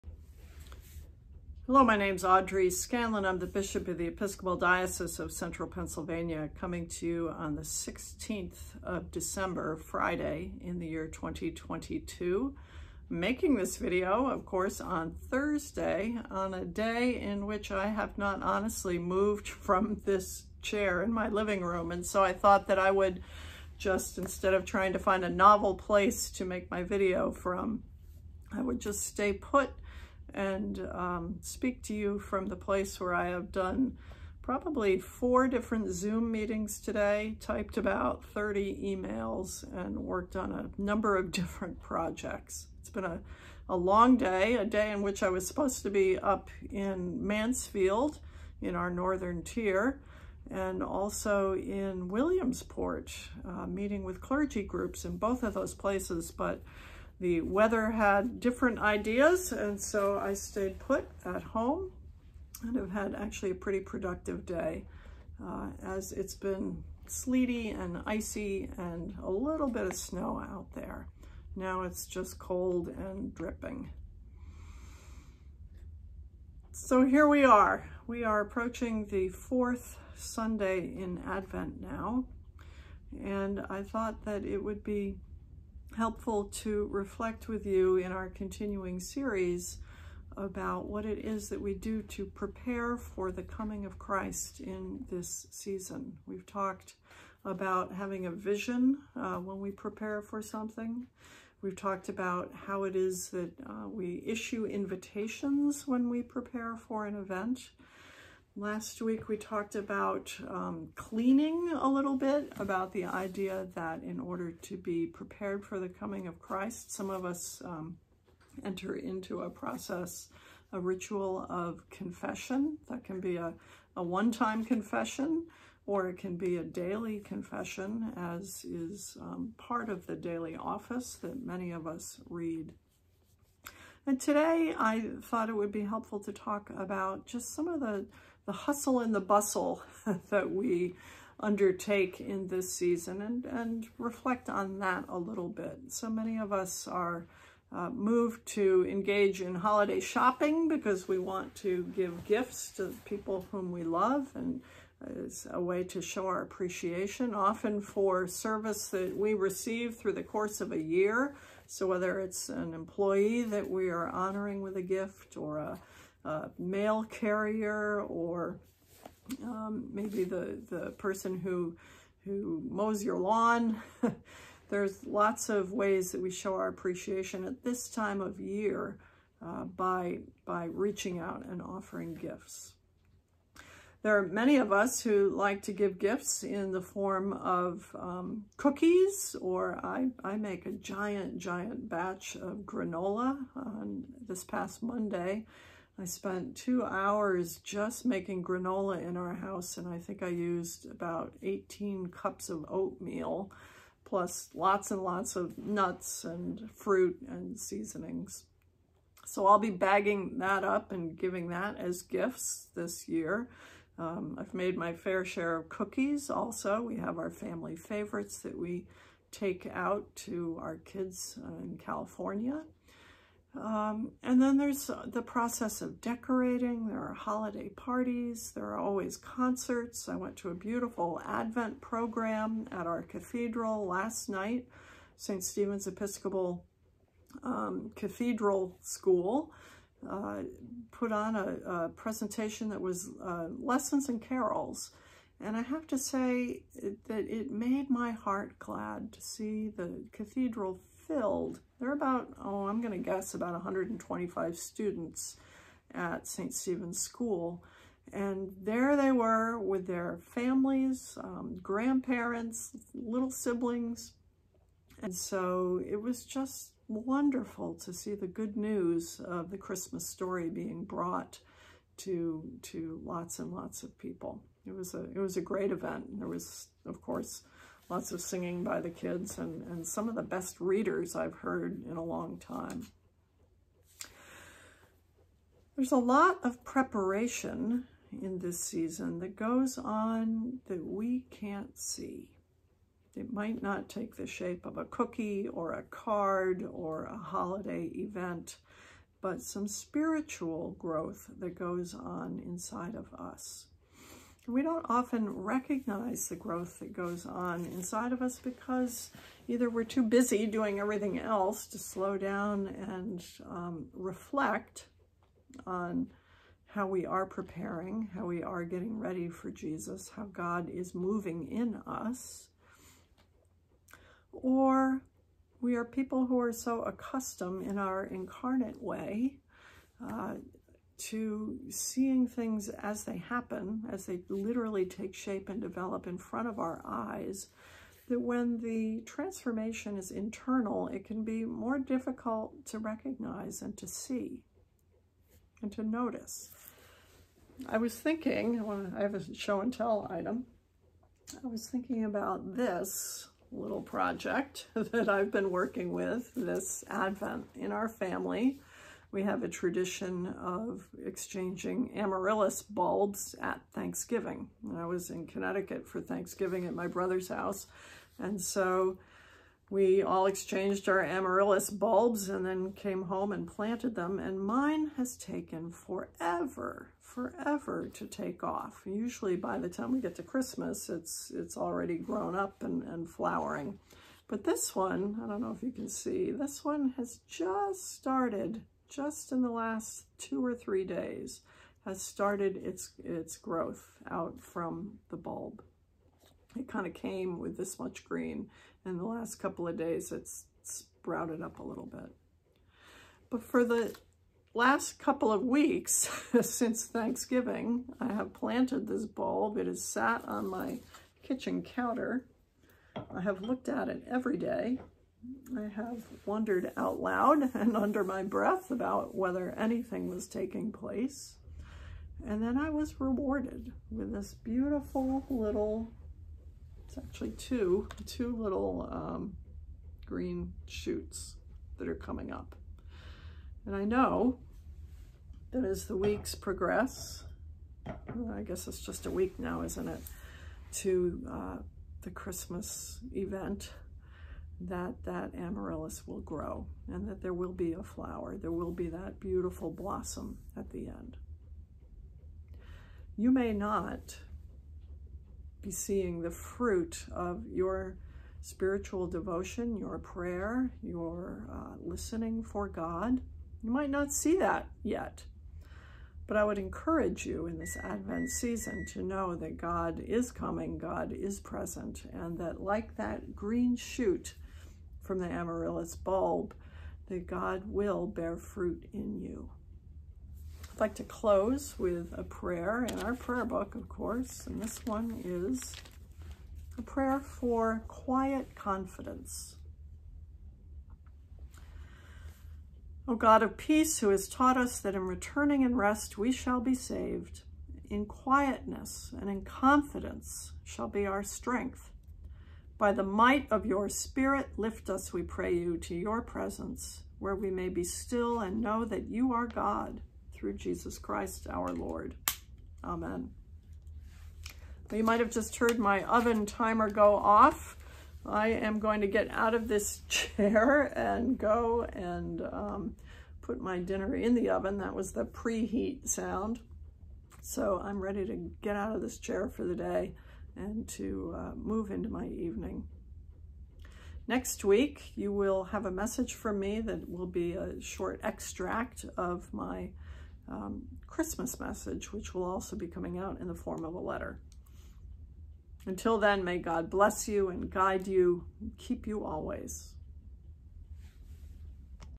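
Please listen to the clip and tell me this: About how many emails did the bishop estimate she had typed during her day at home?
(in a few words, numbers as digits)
30.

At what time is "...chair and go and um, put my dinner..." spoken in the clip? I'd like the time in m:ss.
8:40.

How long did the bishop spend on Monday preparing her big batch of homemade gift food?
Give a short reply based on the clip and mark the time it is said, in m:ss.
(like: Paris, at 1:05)
2 hours, at 3:16.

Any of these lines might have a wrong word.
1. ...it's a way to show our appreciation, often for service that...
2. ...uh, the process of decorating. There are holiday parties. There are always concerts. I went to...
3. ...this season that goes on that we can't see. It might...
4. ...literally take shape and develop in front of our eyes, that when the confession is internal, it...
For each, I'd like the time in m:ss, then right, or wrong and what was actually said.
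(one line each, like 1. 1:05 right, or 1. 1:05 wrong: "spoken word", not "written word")
1. 2:35 right
2. 3:44 right
3. 4:48 right
4. 5:34 wrong: "transformation", not "confession".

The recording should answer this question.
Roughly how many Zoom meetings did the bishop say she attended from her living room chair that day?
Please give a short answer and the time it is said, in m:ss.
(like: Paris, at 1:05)
4, at 0:34.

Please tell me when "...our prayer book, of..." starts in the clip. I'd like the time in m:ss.
8:02.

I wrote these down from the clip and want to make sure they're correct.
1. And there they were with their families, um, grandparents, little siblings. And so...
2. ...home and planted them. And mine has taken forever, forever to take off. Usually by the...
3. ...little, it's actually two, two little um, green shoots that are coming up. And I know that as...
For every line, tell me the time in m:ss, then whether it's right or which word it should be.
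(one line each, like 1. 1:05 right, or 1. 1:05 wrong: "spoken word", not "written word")
1. 4:18 right
2. 6:13 right
3. 7:05 right.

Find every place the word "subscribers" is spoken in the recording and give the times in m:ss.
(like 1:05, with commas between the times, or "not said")
not said.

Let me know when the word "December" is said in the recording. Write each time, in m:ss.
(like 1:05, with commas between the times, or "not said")
0:09.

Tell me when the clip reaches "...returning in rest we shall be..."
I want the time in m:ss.
8:15.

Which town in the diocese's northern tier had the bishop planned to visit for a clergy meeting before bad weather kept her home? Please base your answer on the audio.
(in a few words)
Mansfield.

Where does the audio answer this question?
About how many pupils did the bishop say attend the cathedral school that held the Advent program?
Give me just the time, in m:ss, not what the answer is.
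4:13.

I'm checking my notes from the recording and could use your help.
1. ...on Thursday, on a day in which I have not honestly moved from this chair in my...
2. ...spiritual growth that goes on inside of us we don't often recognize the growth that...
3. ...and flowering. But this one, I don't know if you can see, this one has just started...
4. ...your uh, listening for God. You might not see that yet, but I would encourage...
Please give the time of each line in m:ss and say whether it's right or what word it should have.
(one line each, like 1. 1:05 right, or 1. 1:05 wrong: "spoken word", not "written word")
1. 0:14 right
2. 4:59 right
3. 6:22 right
4. 7:40 right.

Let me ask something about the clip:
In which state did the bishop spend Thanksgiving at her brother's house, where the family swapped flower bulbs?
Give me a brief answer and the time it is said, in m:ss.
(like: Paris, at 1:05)
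Connecticut, at 6:05.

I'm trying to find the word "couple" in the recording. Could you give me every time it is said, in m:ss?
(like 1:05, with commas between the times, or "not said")
6:39, 6:44.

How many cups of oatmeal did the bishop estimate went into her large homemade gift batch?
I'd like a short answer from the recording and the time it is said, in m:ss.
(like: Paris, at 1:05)
18, at 3:21.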